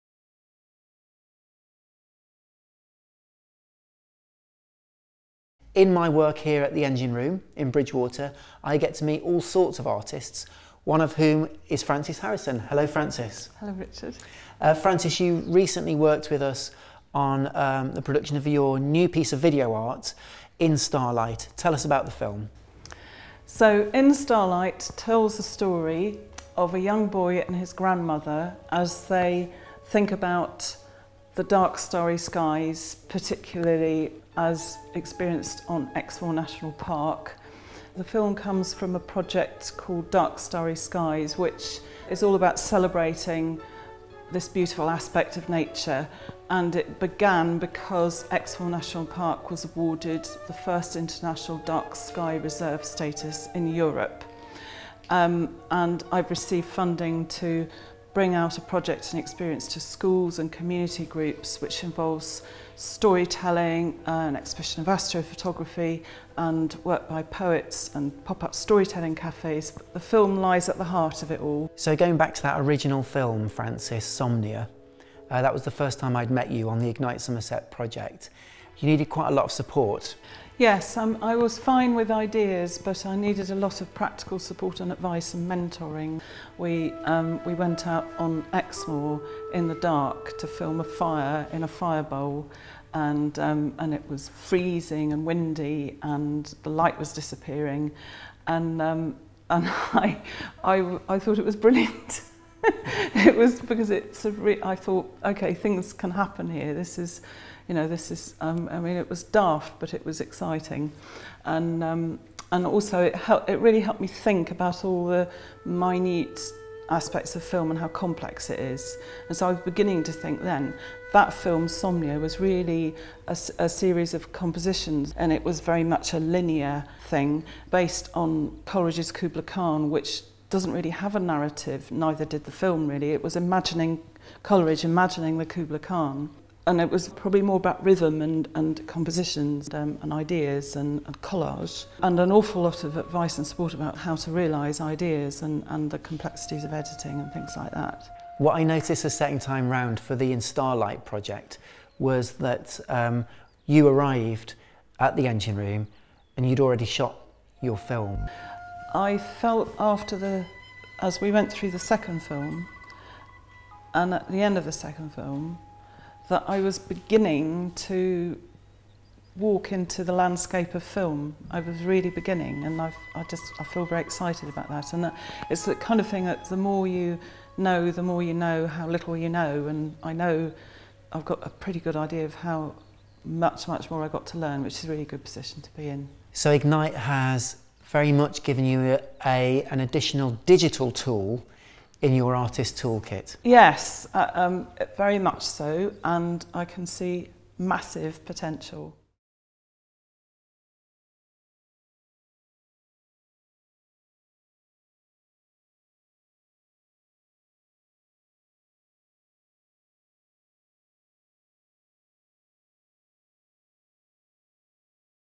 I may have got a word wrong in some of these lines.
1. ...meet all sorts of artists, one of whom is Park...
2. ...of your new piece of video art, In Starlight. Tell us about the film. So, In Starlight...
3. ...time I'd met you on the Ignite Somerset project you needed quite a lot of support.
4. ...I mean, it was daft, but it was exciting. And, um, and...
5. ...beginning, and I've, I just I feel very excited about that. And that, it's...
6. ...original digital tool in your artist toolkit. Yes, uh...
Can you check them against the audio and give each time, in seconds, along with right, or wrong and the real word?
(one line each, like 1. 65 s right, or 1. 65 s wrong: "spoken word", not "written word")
1. 9 s wrong: "Frances", not "Park"
2. 18 s right
3. 75 s right
4. 108 s right
5. 172 s right
6. 189 s wrong: "additional", not "original".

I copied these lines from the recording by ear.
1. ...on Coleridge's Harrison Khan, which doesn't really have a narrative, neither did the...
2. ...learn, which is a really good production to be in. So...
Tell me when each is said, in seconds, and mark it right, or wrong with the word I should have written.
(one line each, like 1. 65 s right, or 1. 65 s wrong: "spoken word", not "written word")
1. 128 s wrong: "Kubla", not "Harrison"
2. 184 s wrong: "position", not "production".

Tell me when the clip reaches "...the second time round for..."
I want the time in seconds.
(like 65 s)
149 s.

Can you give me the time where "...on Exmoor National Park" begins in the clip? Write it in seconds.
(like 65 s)
35 s.